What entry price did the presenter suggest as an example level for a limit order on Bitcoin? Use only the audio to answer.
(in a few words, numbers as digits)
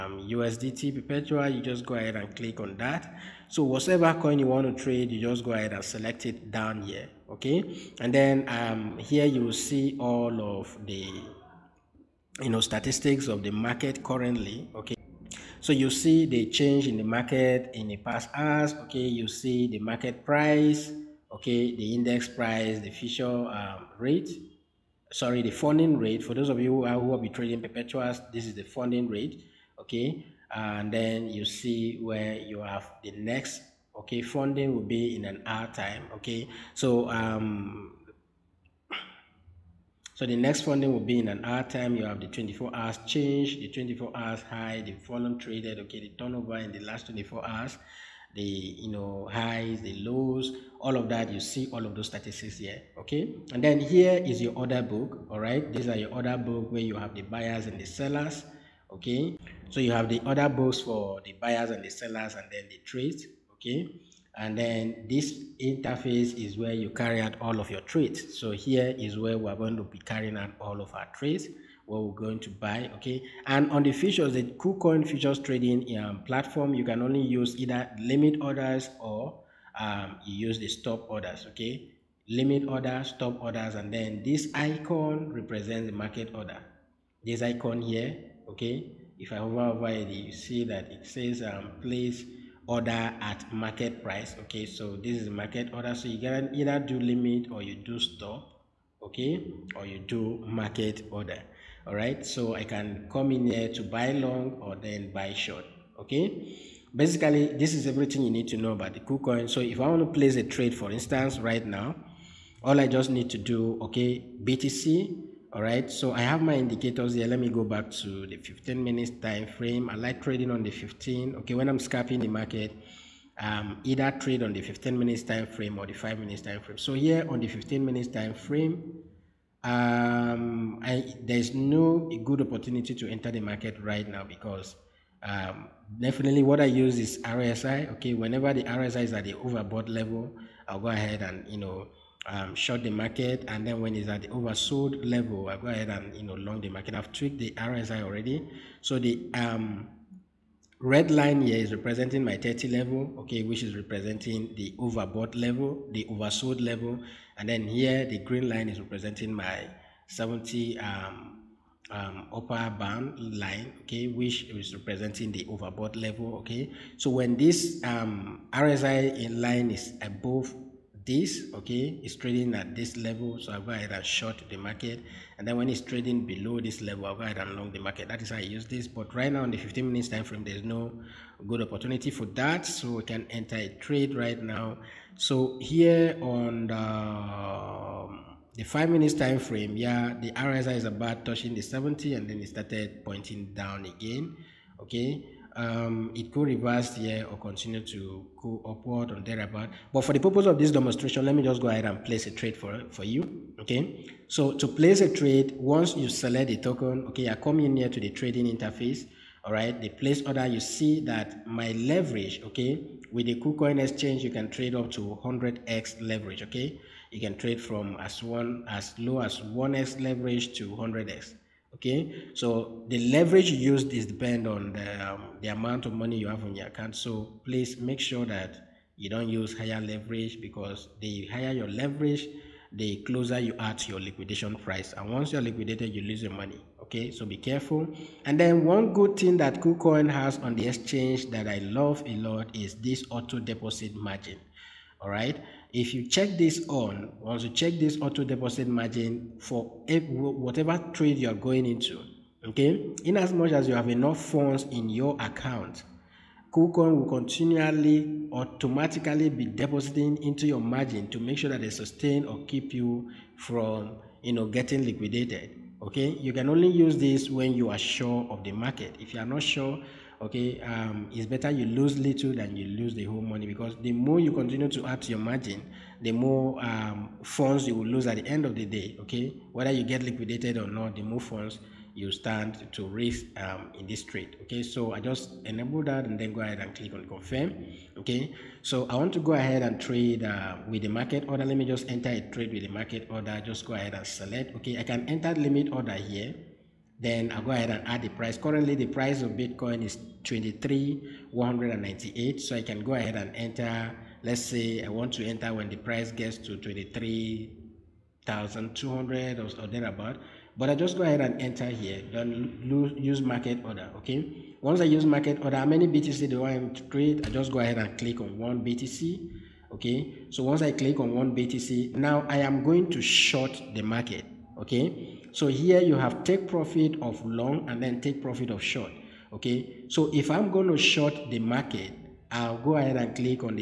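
23,200.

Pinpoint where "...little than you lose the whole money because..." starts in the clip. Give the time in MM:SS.
04:31.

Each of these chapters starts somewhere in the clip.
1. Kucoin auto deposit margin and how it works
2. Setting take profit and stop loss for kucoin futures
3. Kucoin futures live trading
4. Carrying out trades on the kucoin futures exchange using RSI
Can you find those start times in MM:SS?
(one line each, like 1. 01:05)
1. 03:59
2. 05:25
3. 03:19
4. 01:49.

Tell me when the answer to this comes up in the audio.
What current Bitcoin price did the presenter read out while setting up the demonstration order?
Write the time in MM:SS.
05:00.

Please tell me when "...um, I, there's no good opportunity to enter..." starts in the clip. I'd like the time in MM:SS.
02:09.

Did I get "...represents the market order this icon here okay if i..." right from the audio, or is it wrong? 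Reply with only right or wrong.
right.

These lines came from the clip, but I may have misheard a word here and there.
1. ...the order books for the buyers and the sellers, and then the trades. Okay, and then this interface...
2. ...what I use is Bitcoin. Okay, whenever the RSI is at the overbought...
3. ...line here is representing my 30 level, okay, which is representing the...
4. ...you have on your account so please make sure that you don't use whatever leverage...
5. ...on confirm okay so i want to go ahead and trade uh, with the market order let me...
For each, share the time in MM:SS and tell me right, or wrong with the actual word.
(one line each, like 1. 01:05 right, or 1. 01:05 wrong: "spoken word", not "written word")
1. 01:00 right
2. 02:16 wrong: "RSI", not "Bitcoin"
3. 02:31 right
4. 03:46 wrong: "higher", not "whatever"
5. 04:46 right.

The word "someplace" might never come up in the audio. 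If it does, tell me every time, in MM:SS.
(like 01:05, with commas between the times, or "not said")
not said.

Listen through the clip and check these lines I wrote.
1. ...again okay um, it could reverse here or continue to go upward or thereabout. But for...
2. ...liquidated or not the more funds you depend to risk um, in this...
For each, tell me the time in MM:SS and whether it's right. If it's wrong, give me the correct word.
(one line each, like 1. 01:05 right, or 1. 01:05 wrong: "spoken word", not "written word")
1. 03:13 right
2. 04:40 wrong: "stand", not "depend".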